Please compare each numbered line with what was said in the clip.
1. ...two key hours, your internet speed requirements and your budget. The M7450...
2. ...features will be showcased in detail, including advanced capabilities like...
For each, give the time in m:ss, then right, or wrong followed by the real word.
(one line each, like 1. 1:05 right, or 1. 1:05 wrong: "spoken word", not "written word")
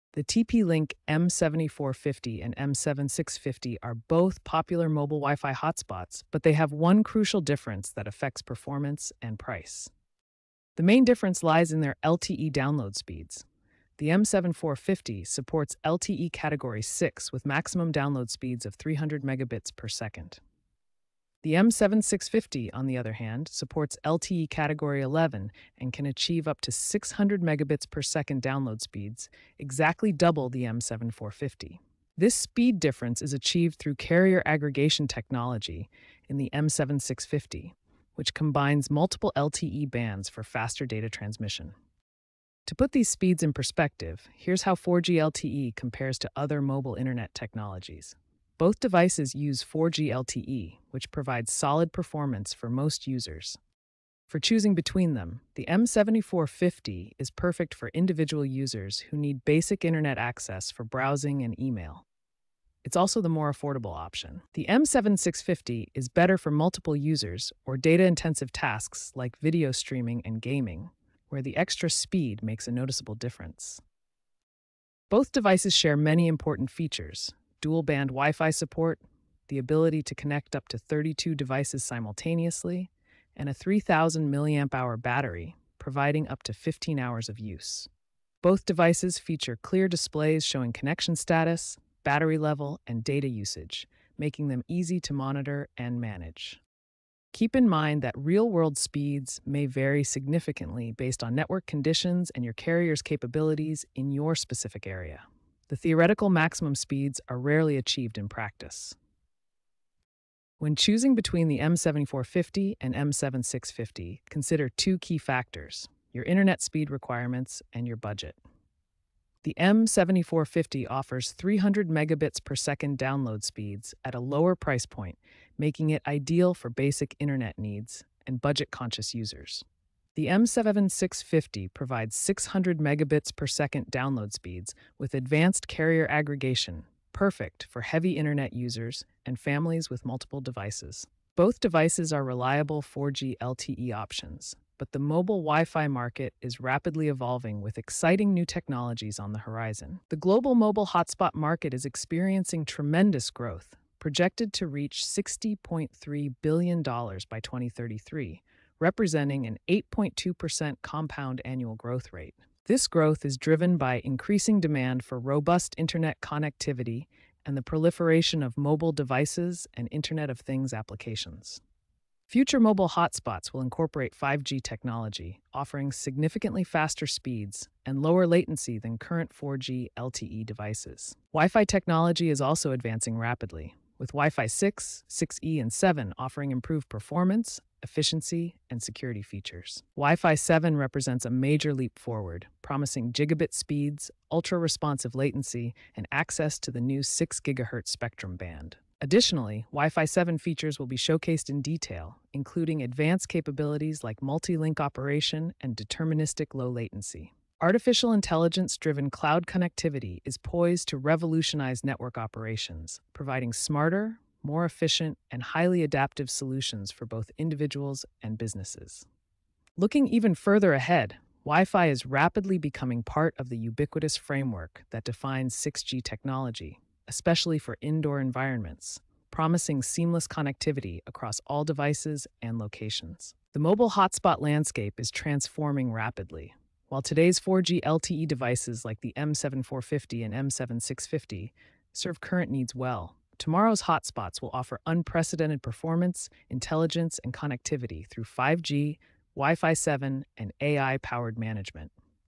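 1. 1:54 wrong: "factors", not "hours"
2. 3:20 right.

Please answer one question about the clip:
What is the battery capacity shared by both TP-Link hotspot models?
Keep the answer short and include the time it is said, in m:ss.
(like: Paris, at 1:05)
3000 mAh, at 1:23.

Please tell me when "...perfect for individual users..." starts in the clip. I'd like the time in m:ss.
0:57.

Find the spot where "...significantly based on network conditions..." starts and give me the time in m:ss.
1:40.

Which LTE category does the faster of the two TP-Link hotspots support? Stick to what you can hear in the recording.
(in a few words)
Category 11.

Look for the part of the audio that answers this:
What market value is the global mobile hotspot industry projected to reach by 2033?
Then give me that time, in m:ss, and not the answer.
2:35.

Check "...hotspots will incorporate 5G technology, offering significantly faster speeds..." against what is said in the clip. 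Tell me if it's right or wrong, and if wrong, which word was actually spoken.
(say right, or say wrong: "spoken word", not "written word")
right.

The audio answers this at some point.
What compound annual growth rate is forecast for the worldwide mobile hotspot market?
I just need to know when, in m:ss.
2:39.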